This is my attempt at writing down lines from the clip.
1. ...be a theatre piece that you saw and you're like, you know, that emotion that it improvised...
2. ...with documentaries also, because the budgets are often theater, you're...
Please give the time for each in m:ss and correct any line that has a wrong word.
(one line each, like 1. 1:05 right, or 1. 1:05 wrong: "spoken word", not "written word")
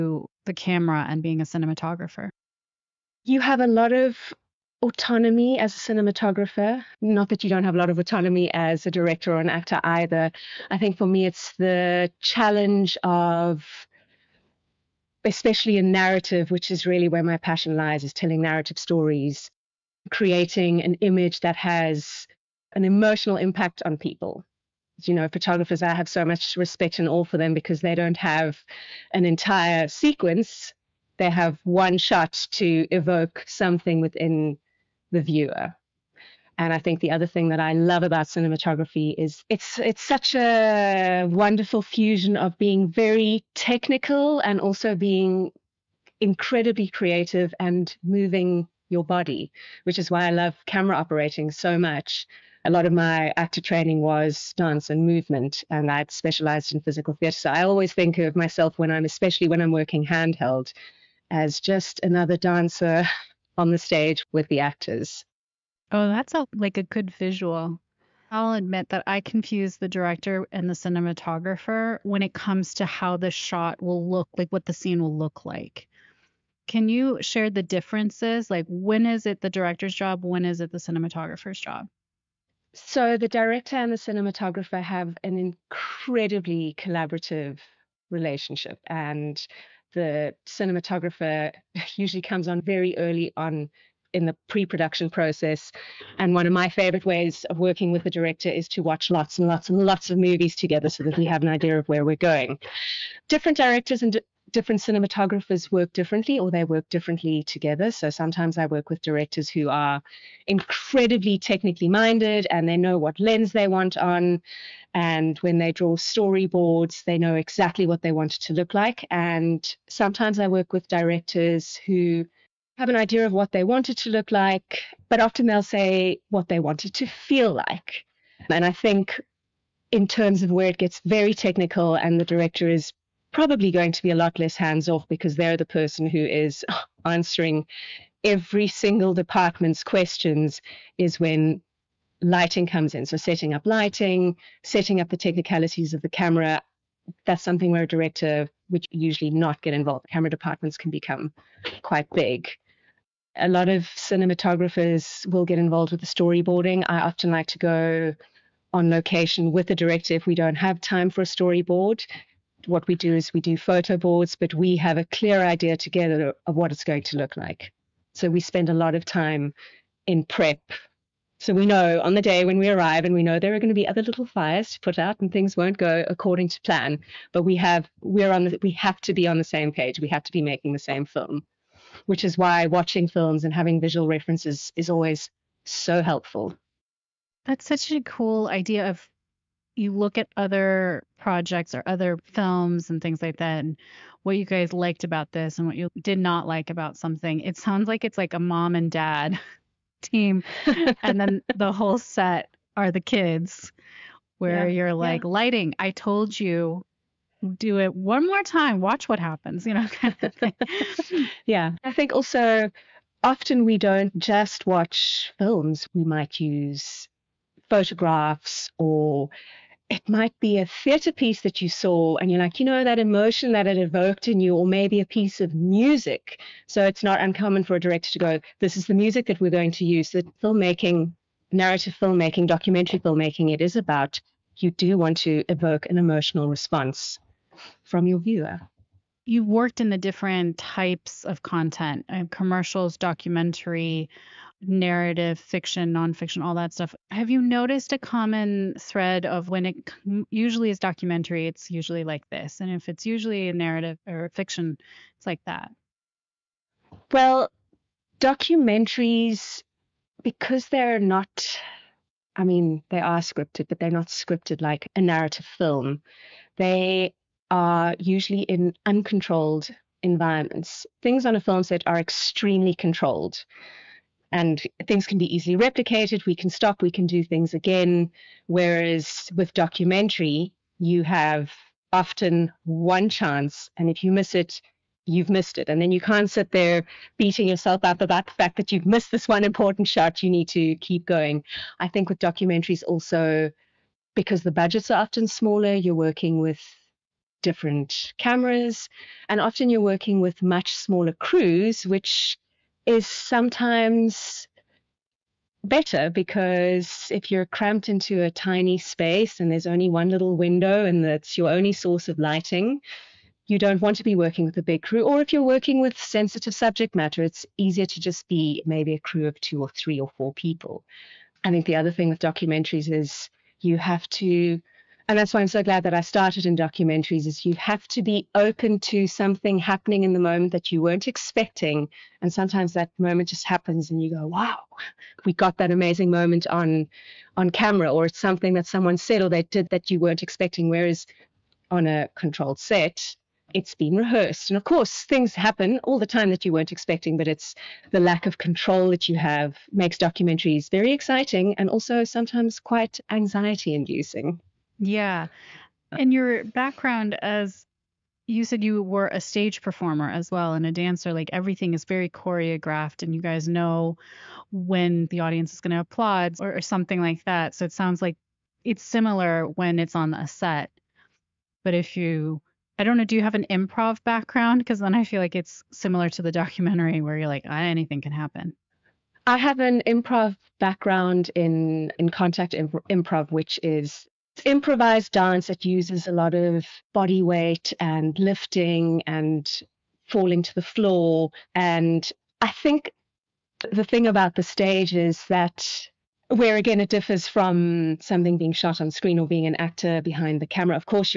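1. 3:40 wrong: "evoked", not "improvised"
2. 4:52 wrong: "smaller", not "theater".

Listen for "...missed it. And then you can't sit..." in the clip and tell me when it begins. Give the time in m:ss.
4:45.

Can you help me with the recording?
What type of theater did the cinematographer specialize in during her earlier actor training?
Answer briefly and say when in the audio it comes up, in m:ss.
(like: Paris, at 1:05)
Physical theater, at 0:56.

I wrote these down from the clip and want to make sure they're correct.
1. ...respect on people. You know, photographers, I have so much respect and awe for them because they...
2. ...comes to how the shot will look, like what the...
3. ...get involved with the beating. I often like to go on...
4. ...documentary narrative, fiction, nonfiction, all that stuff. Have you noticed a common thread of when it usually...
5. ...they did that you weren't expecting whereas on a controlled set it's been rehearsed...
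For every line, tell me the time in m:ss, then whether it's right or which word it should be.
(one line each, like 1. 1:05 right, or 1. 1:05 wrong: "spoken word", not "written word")
1. 0:23 wrong: "impact", not "respect"
2. 1:12 right
3. 2:35 wrong: "storyboarding", not "beating"
4. 4:02 right
5. 5:39 right.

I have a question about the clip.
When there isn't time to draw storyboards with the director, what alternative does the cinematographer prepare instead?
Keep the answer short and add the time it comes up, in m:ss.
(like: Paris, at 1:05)
Photo boards, at 2:43.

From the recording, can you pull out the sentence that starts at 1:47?
So sometimes I work with directors who are incredibly technically minded and they know what lens they want on.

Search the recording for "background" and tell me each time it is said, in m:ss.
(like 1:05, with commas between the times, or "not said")
5:56, 6:14, 6:20.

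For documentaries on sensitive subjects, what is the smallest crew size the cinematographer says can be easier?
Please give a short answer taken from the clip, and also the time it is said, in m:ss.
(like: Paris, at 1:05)
2, at 5:19.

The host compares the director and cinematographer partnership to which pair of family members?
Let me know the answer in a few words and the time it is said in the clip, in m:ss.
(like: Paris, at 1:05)
Mom and dad, at 3:18.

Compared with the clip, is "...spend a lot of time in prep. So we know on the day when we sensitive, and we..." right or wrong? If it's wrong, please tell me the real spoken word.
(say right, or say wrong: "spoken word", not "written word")
wrong: "arrive", not "sensitive".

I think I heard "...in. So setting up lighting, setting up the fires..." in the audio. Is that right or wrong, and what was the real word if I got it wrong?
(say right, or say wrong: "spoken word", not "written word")
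wrong: "technicalities", not "fires".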